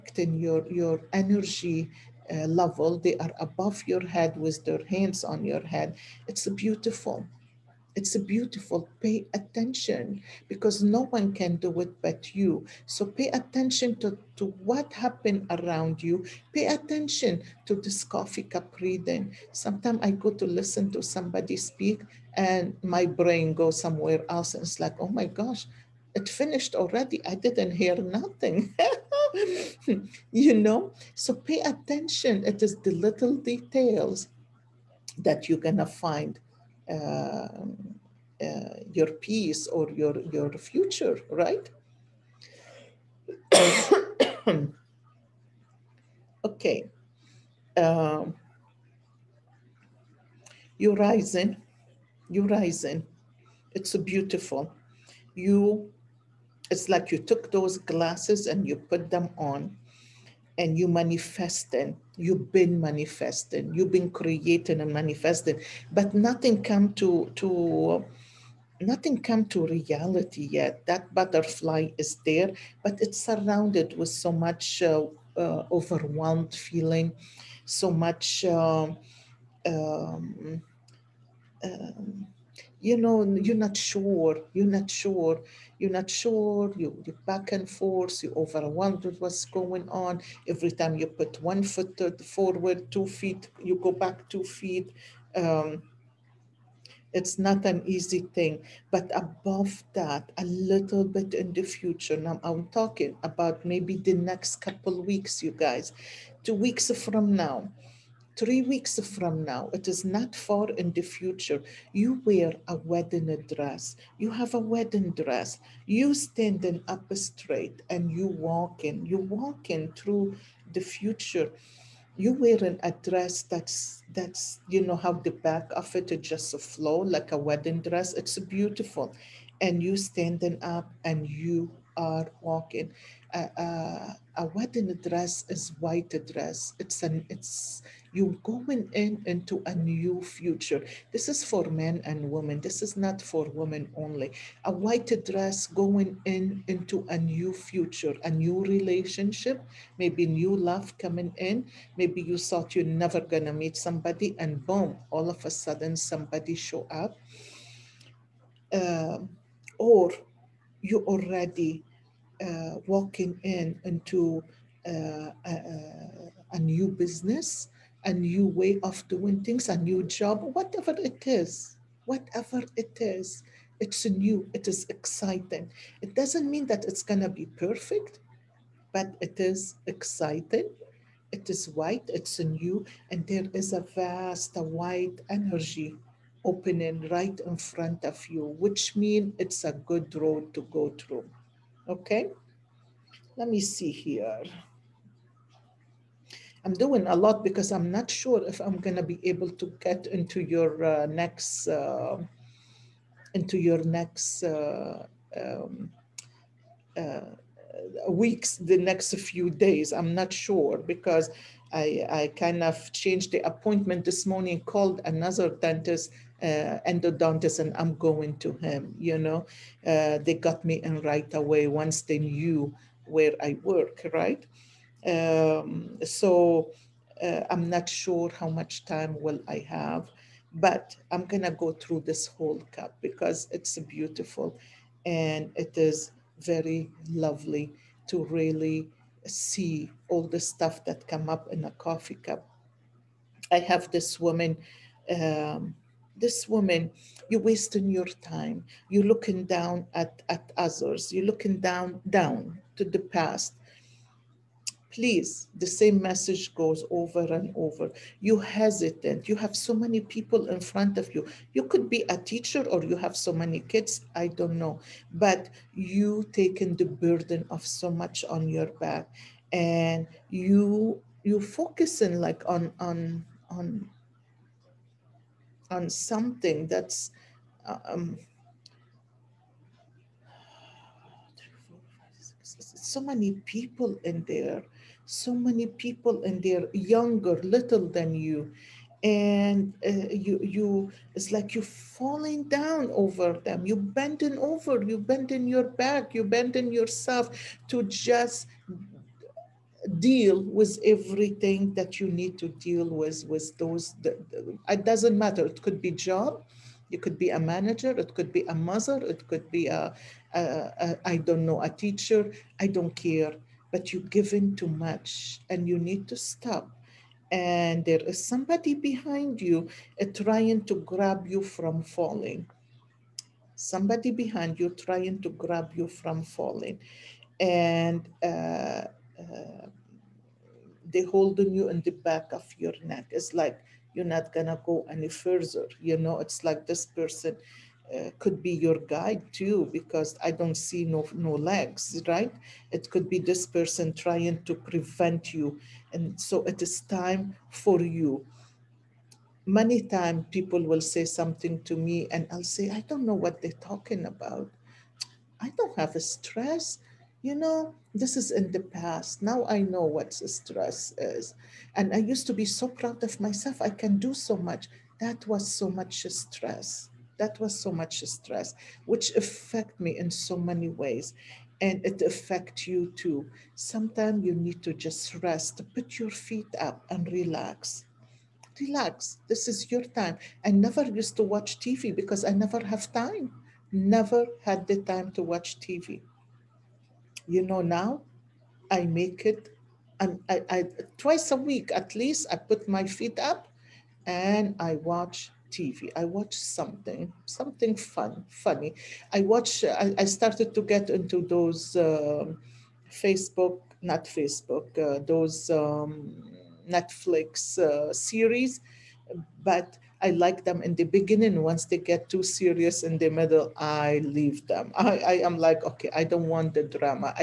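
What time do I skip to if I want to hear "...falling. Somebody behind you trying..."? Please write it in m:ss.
5:21.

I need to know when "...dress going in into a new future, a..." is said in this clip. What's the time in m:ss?
2:25.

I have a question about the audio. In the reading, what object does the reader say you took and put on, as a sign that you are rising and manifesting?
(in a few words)
glasses.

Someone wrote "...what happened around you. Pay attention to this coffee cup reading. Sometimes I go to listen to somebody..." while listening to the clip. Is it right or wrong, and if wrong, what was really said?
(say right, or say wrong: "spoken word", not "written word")
right.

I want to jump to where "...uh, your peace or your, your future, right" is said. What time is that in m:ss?
0:36.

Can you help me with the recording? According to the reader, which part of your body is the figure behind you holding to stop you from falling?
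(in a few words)
neck.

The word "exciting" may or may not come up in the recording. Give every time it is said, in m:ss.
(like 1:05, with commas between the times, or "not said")
2:54, 2:59.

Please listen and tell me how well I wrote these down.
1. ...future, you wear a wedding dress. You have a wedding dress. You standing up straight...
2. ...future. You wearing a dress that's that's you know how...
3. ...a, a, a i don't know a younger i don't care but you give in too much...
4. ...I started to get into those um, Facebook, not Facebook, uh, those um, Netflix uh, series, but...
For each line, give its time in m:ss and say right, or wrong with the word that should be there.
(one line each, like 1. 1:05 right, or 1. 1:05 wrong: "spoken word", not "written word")
1. 1:51 right
2. 2:00 right
3. 5:09 wrong: "teacher", not "younger"
4. 6:39 right.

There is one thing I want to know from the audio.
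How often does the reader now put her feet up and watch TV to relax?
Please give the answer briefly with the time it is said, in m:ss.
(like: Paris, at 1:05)
twice a week, at 6:30.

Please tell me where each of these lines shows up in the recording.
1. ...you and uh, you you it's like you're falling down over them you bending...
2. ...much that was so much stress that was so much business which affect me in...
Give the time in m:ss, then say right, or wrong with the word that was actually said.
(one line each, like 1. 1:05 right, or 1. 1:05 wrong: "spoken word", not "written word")
1. 4:48 right
2. 6:04 wrong: "stress", not "business".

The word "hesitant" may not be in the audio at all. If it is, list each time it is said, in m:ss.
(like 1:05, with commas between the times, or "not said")
4:18.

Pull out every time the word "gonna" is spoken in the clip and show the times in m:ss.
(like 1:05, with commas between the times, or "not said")
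2:33, 2:57, 3:51.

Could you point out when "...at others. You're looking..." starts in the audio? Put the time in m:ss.
4:10.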